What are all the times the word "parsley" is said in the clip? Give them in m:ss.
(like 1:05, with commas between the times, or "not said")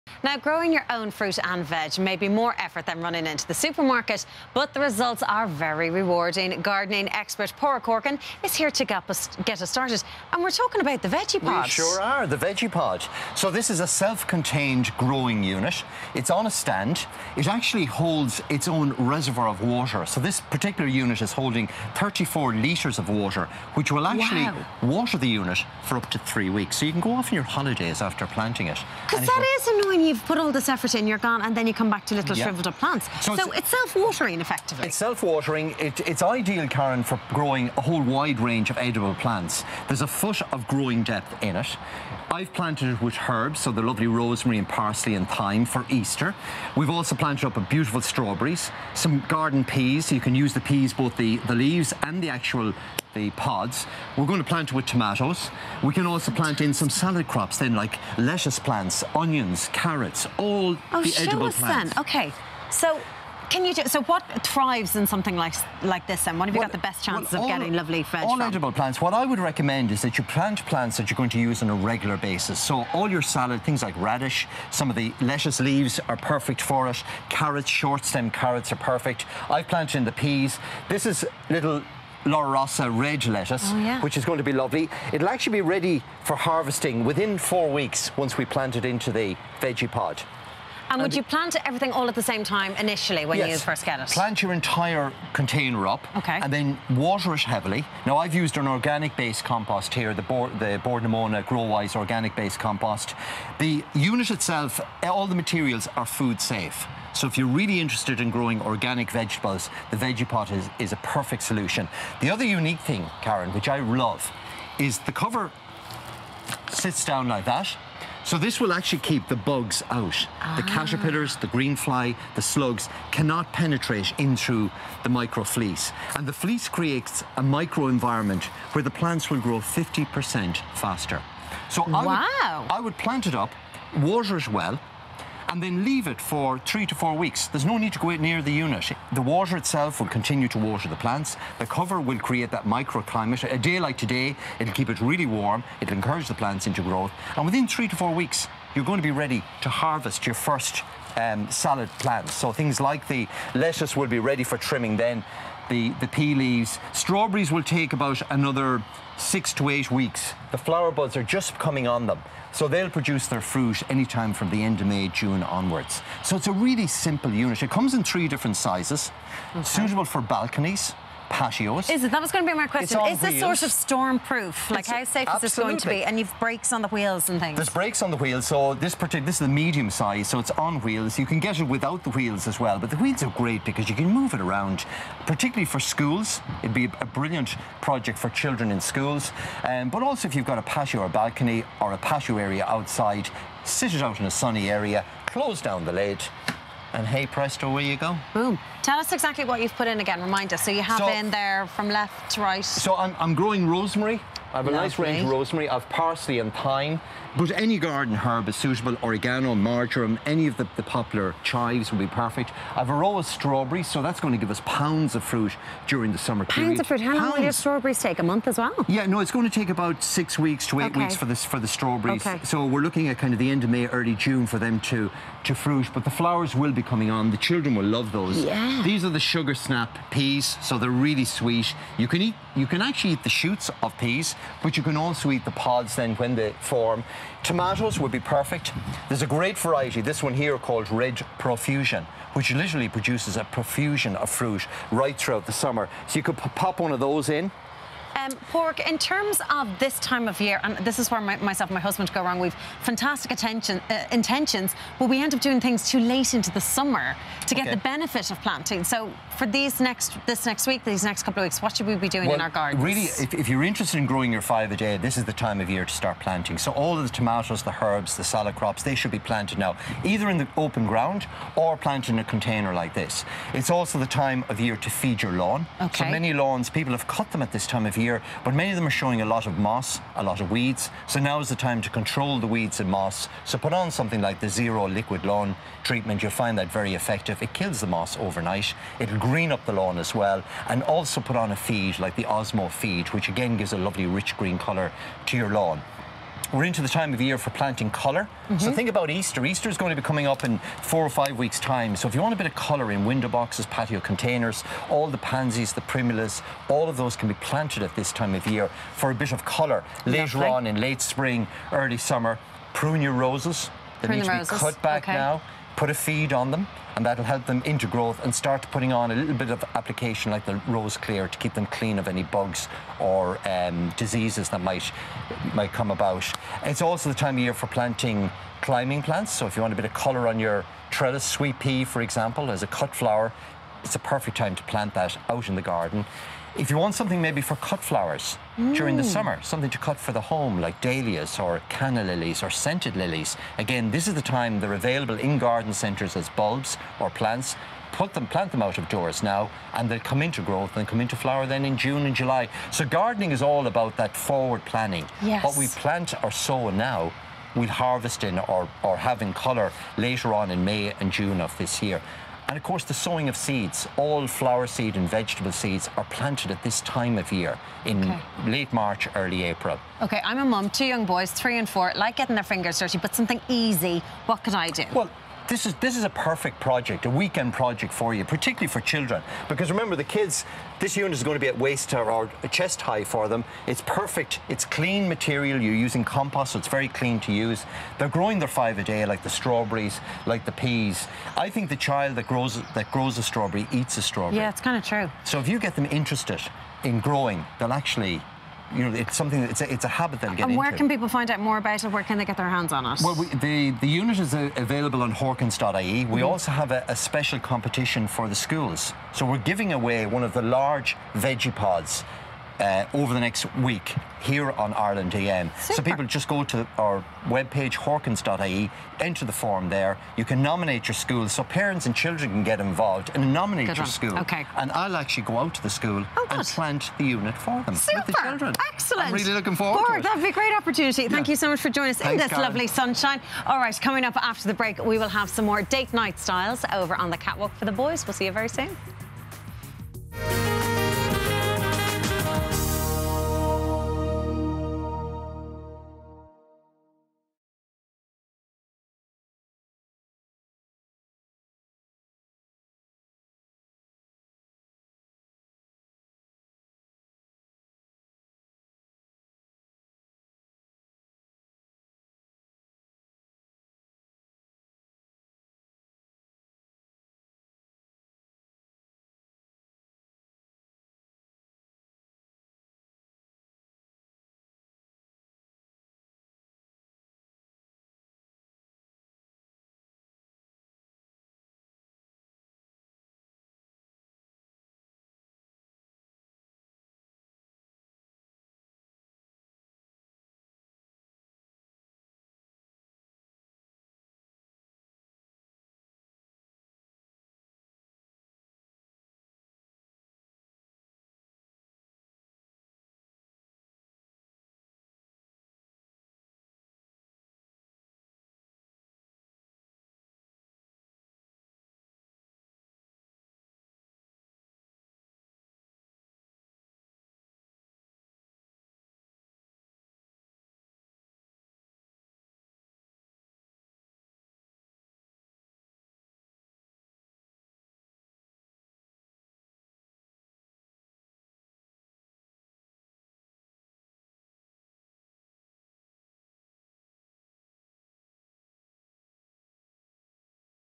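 0:44, 3:25.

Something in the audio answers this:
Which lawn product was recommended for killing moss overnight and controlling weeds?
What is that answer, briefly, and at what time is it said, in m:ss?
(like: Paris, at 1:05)
Zero Liquid Lawn Treatment, at 4:44.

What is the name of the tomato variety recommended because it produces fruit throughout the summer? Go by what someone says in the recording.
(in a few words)
Red Profusion.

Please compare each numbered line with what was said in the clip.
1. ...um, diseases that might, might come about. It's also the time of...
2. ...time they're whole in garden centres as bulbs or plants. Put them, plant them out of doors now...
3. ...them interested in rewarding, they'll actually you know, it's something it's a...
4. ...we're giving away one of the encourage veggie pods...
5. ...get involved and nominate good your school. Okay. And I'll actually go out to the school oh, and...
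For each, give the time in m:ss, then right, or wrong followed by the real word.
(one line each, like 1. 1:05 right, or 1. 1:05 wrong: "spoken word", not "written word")
1. 5:23 right
2. 5:44 wrong: "available", not "whole"
3. 6:35 wrong: "growing", not "rewarding"
4. 6:49 wrong: "large", not "encourage"
5. 7:02 right.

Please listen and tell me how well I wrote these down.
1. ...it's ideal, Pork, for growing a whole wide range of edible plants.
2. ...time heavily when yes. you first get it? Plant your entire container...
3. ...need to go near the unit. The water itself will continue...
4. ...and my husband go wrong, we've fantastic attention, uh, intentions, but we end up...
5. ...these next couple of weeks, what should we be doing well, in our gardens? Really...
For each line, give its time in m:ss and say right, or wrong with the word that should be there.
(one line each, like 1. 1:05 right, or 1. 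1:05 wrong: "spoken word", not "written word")
1. 0:36 wrong: "Karen", not "Pork"
2. 1:32 wrong: "initially", not "heavily"
3. 2:17 right
4. 4:11 right
5. 4:20 right.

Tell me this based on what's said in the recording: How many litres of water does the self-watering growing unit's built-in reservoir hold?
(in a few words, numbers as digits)
34.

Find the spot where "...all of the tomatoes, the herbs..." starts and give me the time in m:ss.
4:26.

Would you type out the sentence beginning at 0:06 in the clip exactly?
Gardening expert Paraic Horkan is here to get us, get us started, and we're talking about the Vegepod.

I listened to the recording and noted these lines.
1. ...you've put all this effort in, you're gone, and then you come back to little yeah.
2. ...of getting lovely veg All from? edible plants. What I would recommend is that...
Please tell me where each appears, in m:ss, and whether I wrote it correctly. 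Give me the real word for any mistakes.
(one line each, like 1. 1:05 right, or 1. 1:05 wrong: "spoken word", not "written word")
1. 0:30 right
2. 1:07 right.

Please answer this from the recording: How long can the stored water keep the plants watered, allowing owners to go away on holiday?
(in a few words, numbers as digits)
3 weeks.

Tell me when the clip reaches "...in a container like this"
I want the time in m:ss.
4:32.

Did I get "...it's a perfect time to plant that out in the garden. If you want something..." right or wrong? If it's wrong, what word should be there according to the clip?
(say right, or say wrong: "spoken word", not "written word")
right.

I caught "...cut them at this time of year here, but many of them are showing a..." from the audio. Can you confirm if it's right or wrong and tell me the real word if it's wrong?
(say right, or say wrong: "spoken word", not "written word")
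right.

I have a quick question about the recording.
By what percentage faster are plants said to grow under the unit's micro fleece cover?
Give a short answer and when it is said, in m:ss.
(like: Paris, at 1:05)
50%, at 2:09.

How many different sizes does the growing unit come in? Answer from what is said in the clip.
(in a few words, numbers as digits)
3.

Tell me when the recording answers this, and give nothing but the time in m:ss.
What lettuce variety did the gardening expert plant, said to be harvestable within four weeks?
1:22.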